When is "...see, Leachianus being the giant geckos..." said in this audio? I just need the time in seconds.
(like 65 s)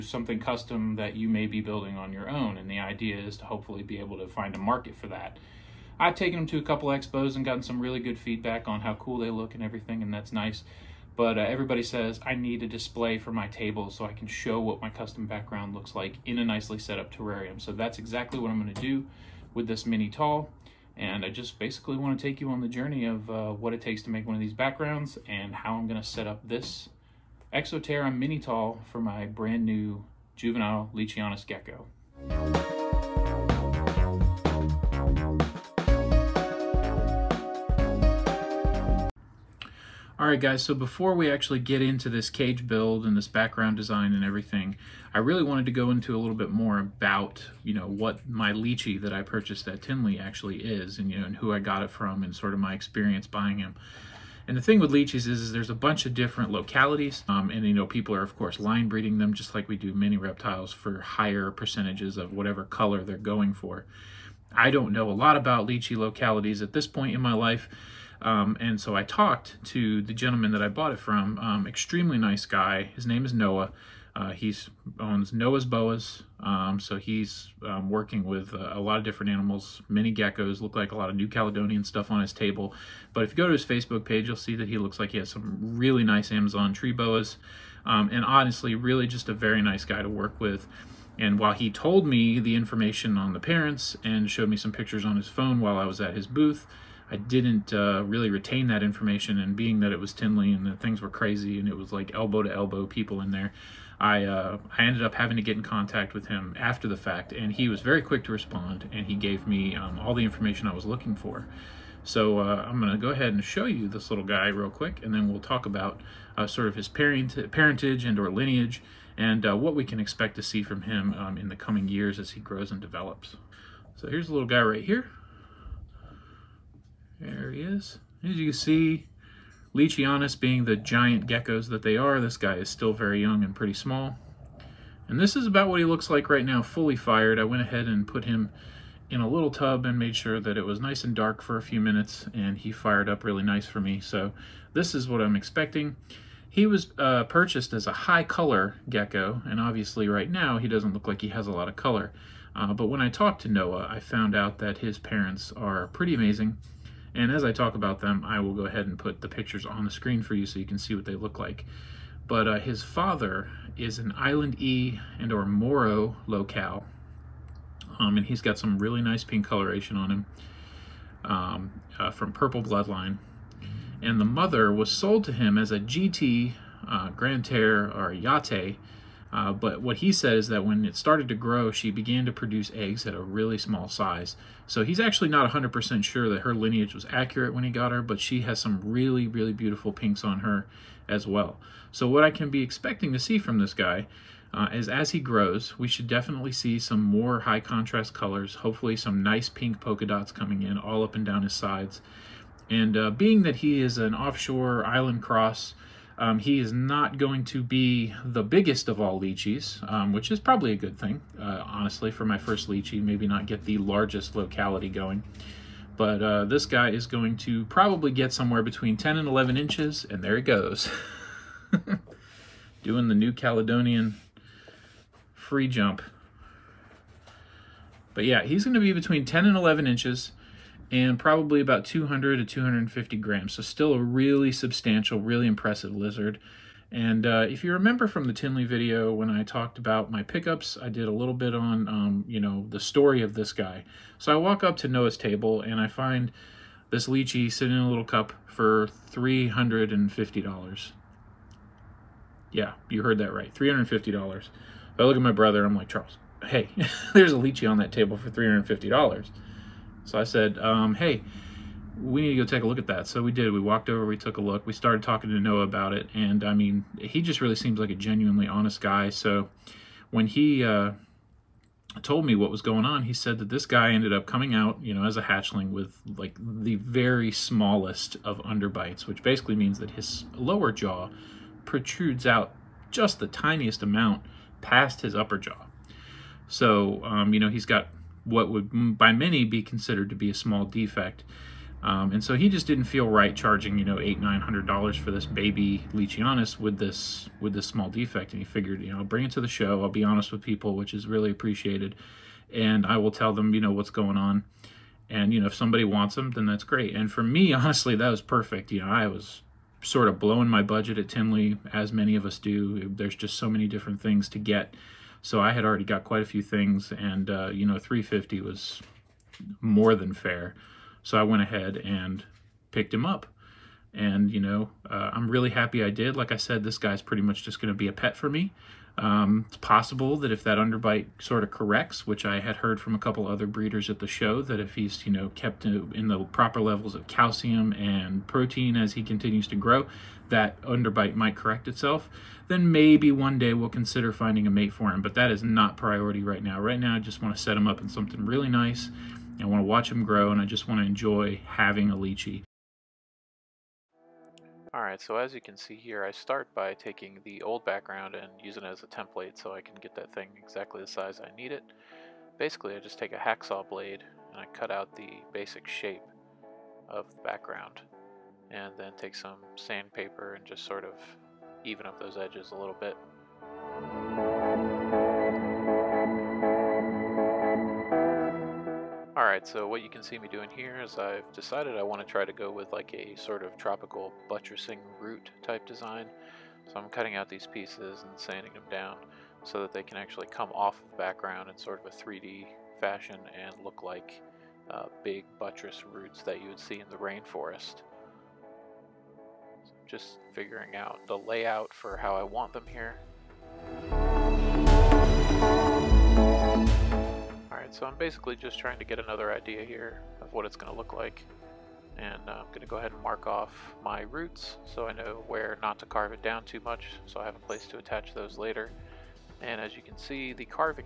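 128 s.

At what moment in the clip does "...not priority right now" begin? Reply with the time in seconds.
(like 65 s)
345 s.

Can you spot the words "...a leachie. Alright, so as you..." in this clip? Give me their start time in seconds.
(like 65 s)
351 s.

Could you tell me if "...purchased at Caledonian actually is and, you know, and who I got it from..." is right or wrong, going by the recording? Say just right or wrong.
wrong.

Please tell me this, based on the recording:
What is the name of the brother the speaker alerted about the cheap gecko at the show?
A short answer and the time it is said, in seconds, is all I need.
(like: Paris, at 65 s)
Charles, at 255 s.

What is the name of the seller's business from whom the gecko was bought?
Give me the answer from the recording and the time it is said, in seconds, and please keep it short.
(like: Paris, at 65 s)
Noah's Boas, at 75 s.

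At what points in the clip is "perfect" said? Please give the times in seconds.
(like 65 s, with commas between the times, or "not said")
308 s.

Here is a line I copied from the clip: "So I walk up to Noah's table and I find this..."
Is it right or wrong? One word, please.
right.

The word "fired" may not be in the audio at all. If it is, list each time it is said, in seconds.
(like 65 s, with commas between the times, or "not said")
136 s, 142 s.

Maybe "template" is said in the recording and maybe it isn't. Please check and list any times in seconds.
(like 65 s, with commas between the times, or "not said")
358 s.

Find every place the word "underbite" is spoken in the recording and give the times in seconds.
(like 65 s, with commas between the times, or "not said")
278 s, 330 s, 340 s.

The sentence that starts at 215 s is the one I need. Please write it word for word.
But uh, this guy is going to probably get somewhere between 10 and 11 inches, and there he goes.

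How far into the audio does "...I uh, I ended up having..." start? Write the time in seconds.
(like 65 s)
103 s.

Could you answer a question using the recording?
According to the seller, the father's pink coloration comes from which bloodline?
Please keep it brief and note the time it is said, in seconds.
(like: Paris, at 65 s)
Purple Bloodline, at 172 s.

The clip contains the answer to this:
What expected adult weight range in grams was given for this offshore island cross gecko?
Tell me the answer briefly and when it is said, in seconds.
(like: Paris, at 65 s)
200 to 250 grams, at 231 s.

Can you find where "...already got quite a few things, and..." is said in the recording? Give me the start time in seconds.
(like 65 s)
315 s.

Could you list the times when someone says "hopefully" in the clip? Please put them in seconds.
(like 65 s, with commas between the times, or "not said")
3 s, 198 s.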